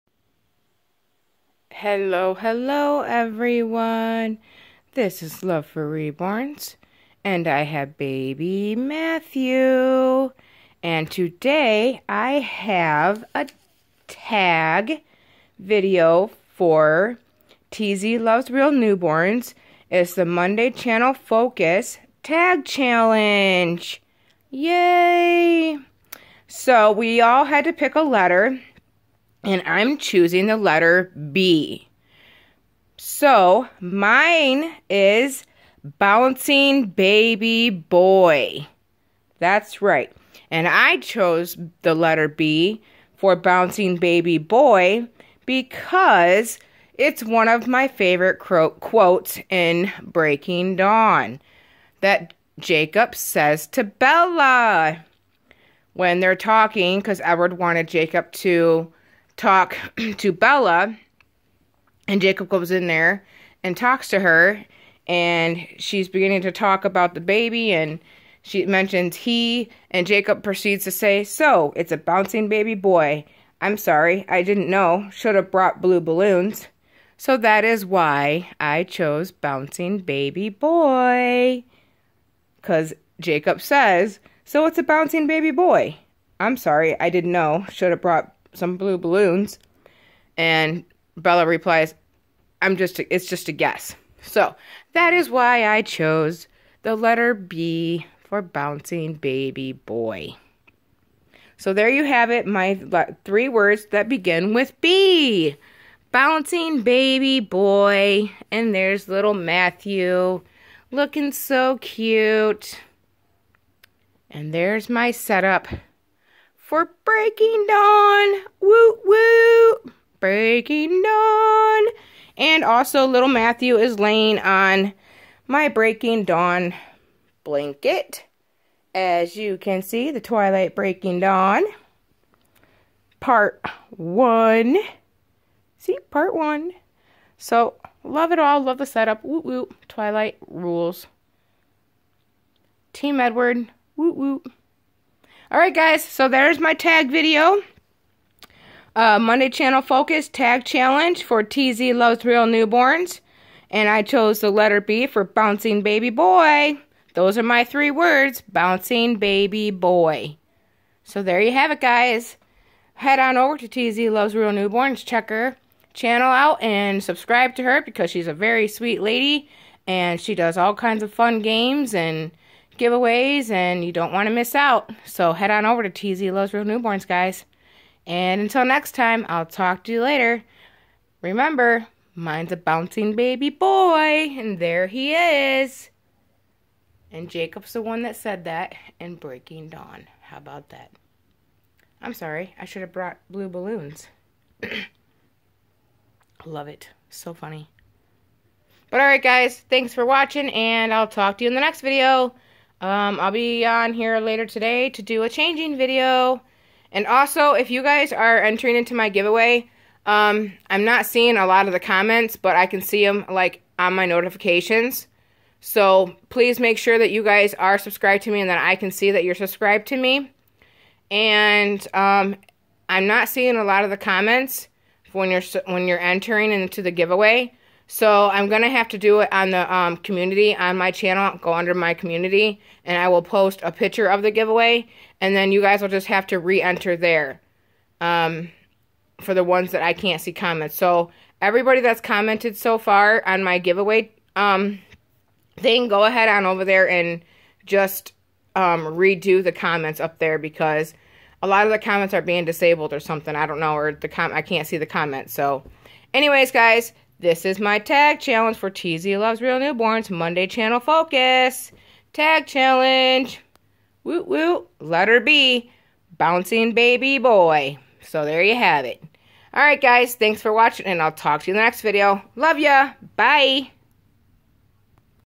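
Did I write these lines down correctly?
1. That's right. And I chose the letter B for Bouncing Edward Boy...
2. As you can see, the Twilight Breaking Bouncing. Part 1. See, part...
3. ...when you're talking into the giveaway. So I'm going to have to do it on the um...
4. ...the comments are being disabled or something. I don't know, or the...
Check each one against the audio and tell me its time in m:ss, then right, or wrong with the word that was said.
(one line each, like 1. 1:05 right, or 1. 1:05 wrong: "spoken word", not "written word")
1. 0:39 wrong: "Baby", not "Edward"
2. 2:08 wrong: "Dawn", not "Bouncing"
3. 3:45 wrong: "entering", not "talking"
4. 4:11 right.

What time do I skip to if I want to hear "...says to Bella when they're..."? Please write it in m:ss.
0:53.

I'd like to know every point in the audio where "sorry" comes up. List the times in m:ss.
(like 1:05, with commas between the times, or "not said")
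1:13, 1:26, 3:12.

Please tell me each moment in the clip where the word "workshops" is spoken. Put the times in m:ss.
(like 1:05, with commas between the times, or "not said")
not said.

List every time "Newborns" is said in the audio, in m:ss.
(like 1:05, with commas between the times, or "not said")
0:18, 2:32, 2:44, 2:56, 4:19.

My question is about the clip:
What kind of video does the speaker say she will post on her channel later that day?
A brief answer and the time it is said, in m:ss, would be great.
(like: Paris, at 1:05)
A changing video, at 3:25.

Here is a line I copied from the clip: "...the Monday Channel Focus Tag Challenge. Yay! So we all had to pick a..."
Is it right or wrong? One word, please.
right.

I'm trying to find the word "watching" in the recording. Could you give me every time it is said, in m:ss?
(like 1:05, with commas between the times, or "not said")
3:20, 4:30.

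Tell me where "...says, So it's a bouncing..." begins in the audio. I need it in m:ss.
1:23.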